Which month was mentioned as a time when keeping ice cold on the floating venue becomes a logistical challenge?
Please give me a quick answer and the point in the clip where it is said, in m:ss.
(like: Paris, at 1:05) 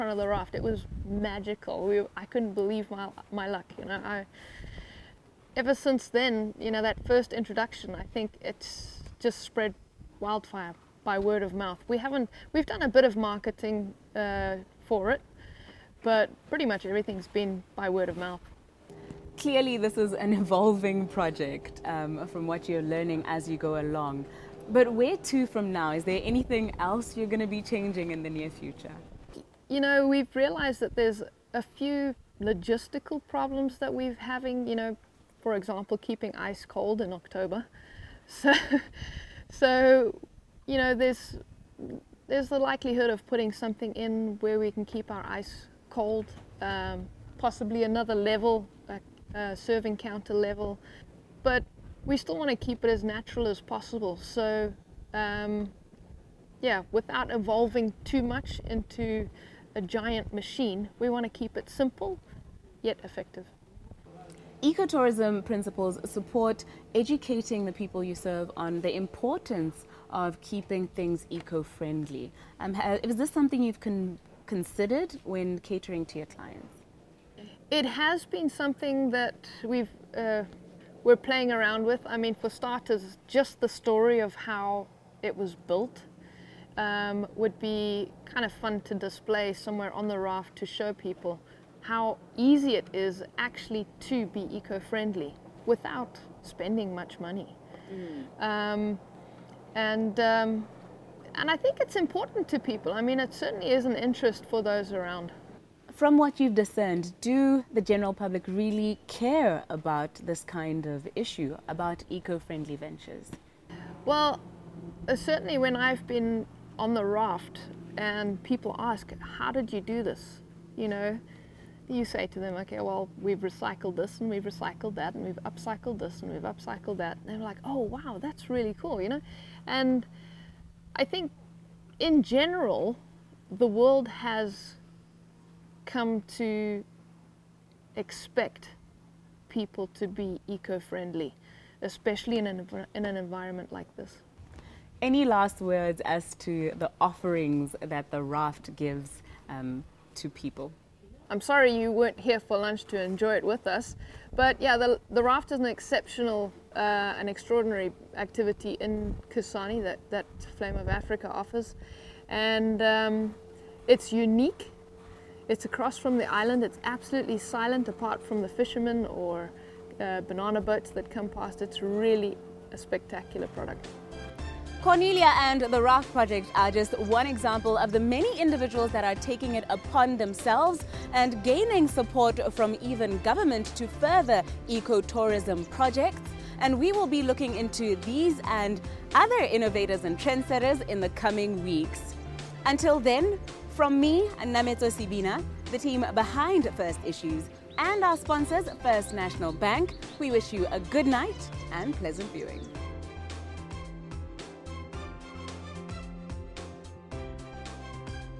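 October, at 0:37.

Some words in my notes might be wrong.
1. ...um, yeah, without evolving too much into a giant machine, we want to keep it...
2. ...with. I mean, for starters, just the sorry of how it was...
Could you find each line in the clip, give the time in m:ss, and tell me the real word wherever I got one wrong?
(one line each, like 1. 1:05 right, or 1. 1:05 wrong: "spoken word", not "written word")
1. 0:55 right
2. 1:21 wrong: "story", not "sorry".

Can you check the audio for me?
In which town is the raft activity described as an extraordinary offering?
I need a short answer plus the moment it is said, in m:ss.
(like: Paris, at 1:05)
Kasane, at 2:39.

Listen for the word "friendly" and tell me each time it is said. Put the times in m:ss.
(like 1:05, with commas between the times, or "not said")
1:11, 1:34, 1:52, 2:20.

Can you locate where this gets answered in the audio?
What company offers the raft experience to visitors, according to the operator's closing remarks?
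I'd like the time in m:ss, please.
2:40.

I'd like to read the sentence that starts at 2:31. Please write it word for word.
I'm sorry you weren't here for lunch to enjoy it with us.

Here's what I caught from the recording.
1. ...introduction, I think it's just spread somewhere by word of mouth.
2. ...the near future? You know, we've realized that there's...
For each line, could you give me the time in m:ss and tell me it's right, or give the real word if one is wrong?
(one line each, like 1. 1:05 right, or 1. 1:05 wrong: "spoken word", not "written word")
1. 0:07 wrong: "wildfire", not "somewhere"
2. 0:28 right.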